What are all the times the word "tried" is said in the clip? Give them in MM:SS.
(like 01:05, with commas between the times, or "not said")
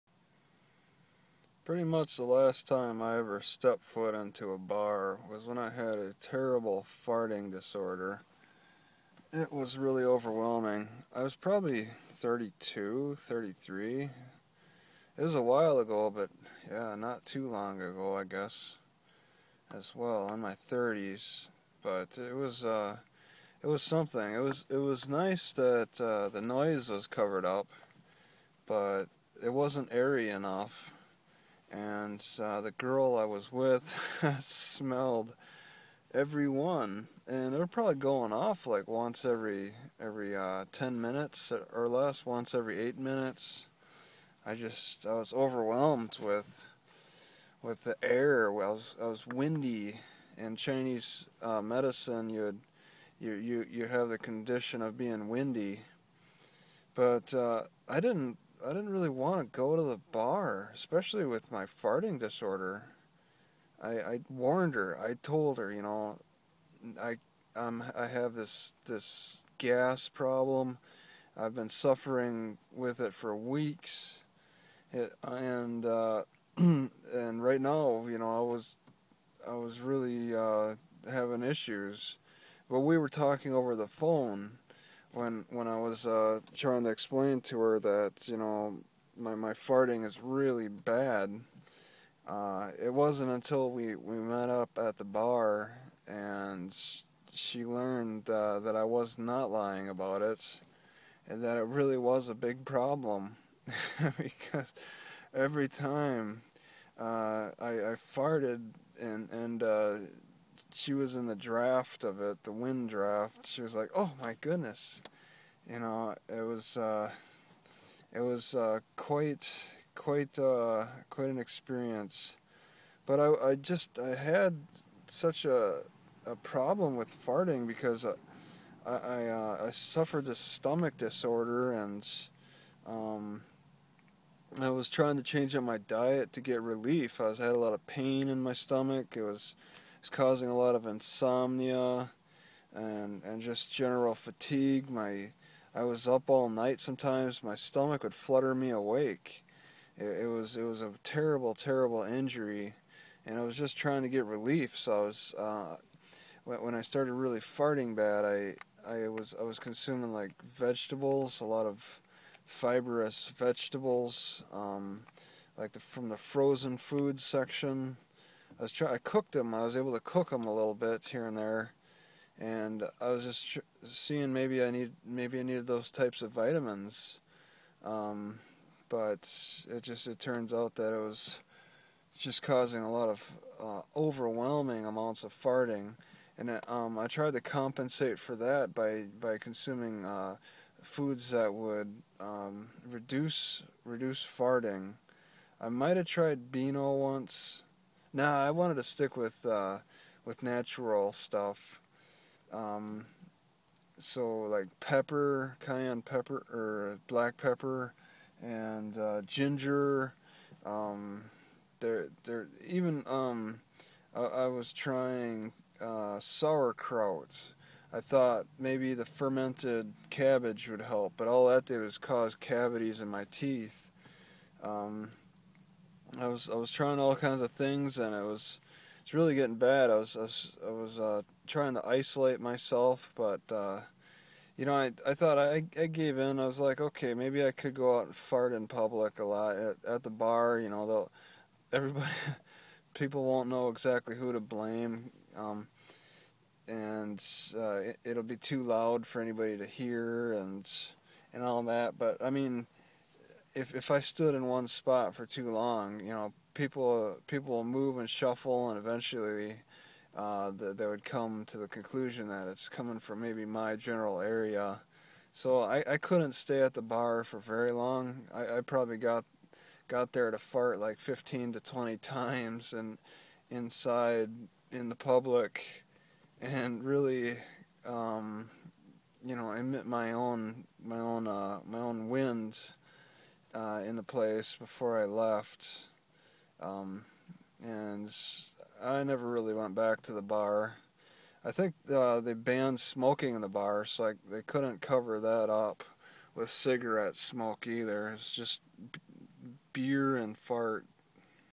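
03:07, 03:16.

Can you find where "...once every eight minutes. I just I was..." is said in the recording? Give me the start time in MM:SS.
00:42.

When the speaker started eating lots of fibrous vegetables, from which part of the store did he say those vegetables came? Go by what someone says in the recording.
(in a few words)
frozen food section.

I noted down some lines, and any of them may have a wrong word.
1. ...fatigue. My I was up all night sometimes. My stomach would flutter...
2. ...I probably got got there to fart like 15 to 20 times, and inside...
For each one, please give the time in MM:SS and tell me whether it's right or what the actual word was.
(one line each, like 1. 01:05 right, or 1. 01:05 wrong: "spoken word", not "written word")
1. 02:24 right
2. 04:28 right.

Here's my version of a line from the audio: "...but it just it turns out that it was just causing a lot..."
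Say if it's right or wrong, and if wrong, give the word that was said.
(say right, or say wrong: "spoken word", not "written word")
right.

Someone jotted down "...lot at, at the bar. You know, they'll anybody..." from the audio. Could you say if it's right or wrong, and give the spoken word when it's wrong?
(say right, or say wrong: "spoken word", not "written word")
wrong: "everybody", not "anybody".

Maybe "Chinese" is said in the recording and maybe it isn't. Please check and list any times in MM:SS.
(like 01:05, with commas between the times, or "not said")
00:50.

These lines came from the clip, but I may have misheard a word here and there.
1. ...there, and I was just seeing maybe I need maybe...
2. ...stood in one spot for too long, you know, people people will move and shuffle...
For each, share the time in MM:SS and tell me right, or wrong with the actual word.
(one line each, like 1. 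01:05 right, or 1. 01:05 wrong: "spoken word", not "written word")
1. 02:51 right
2. 04:13 right.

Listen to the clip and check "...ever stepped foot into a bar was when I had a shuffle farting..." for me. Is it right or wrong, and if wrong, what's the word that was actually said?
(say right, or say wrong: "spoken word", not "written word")
wrong: "terrible", not "shuffle".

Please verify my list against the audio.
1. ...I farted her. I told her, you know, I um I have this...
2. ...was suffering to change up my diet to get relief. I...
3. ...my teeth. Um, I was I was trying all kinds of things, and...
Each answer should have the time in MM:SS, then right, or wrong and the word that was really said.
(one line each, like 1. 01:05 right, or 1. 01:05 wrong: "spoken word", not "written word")
1. 01:03 wrong: "warned", not "farted"
2. 02:14 wrong: "trying", not "suffering"
3. 03:43 right.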